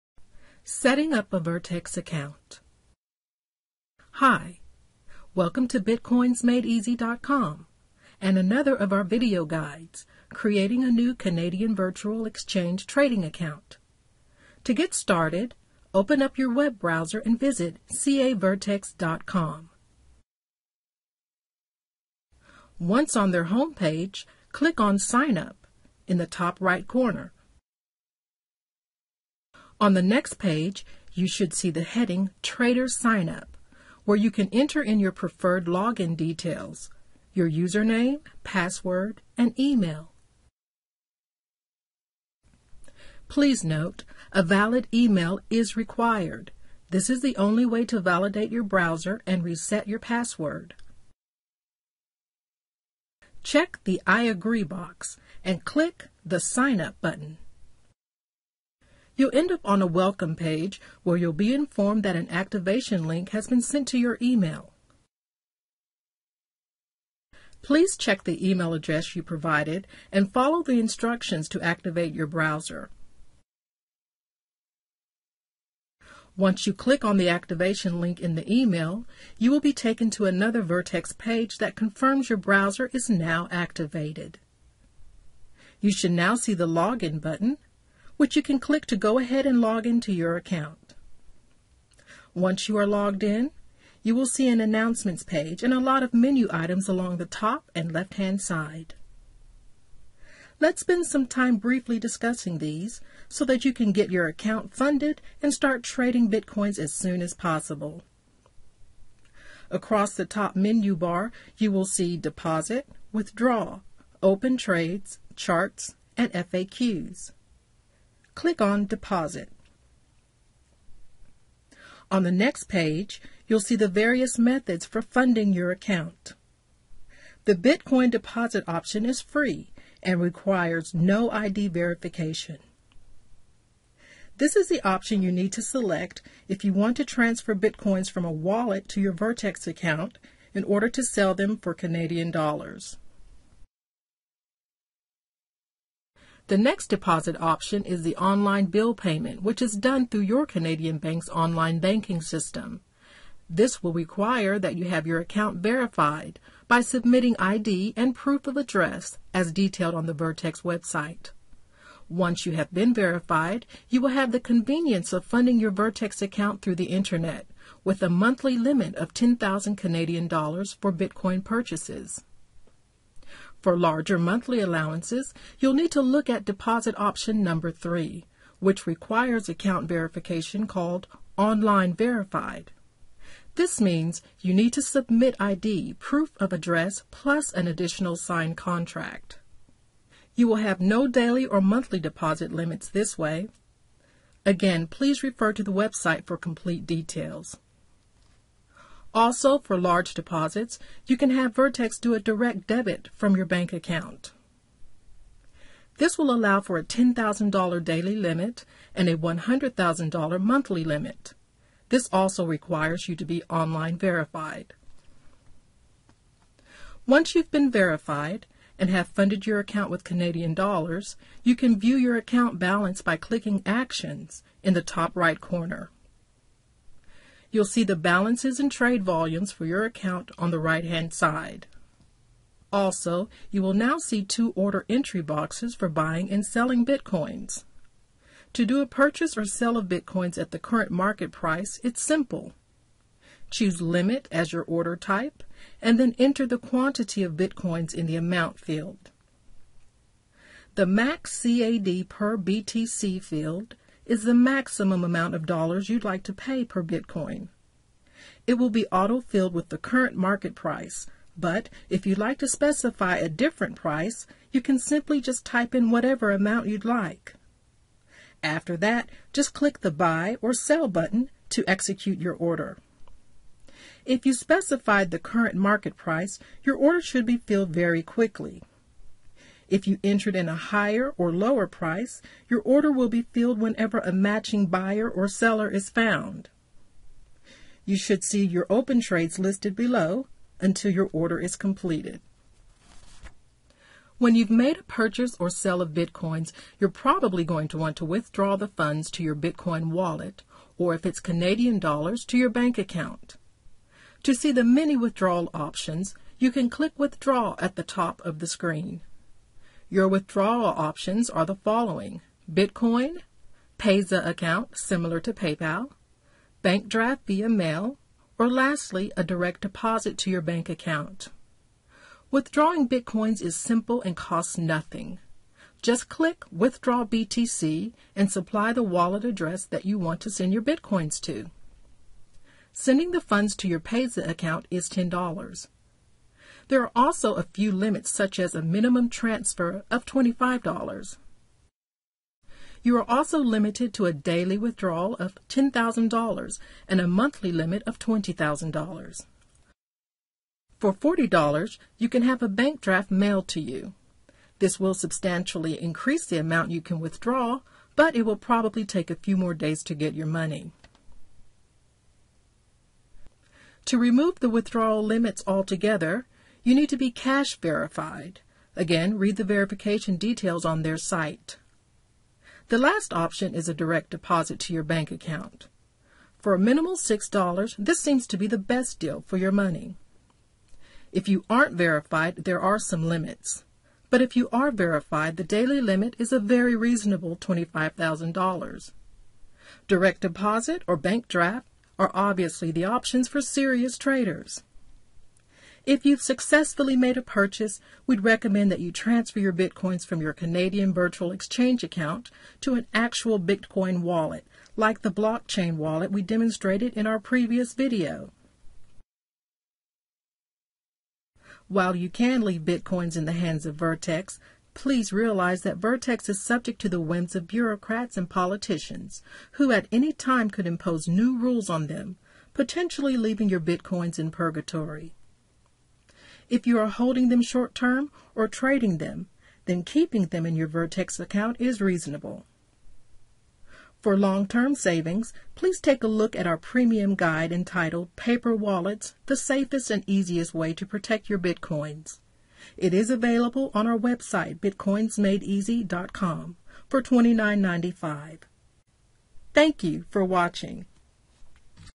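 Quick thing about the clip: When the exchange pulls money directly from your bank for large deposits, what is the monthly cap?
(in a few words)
$100,000.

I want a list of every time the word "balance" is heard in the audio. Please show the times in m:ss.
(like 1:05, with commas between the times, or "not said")
3:42, 3:47.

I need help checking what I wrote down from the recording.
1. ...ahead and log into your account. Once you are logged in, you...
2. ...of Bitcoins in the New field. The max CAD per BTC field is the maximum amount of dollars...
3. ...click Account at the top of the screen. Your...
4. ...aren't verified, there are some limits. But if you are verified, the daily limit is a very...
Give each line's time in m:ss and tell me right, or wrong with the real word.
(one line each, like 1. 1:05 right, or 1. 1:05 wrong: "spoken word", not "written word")
1. 1:29 right
2. 4:07 wrong: "Amount", not "New"
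3. 5:06 wrong: "Withdraw", not "Account"
4. 6:21 right.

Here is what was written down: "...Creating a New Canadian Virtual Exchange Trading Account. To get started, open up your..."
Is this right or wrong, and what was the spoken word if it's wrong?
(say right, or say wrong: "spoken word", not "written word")
right.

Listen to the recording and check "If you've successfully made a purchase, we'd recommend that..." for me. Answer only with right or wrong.
right.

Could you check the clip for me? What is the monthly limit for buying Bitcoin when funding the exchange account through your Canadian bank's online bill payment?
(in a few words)
10,000 Canadian dollars.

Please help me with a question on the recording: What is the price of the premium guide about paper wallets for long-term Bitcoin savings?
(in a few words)
$29.95.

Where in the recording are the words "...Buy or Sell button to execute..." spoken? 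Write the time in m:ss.
4:29.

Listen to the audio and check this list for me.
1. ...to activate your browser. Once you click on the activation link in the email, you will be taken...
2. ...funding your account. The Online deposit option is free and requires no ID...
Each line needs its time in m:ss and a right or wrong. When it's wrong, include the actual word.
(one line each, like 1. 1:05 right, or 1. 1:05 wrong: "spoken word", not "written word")
1. 1:11 right
2. 2:05 wrong: "Bitcoin", not "Online".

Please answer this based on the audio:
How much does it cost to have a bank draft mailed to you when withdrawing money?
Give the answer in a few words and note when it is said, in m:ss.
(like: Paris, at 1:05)
$40, at 5:50.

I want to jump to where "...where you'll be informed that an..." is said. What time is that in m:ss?
1:01.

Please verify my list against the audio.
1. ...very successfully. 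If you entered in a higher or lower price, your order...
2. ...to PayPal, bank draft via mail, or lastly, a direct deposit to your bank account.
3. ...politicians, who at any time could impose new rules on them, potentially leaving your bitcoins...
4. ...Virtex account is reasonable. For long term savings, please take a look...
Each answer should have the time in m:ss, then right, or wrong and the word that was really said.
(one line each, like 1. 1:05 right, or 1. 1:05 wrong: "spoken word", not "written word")
1. 4:37 wrong: "quickly", not "successfully"
2. 5:15 right
3. 6:58 right
4. 7:10 right.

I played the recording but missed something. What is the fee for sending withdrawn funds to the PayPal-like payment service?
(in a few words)
$10.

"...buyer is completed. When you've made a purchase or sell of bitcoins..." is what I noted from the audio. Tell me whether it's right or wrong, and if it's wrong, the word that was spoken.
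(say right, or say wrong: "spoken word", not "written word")
wrong: "order", not "buyer".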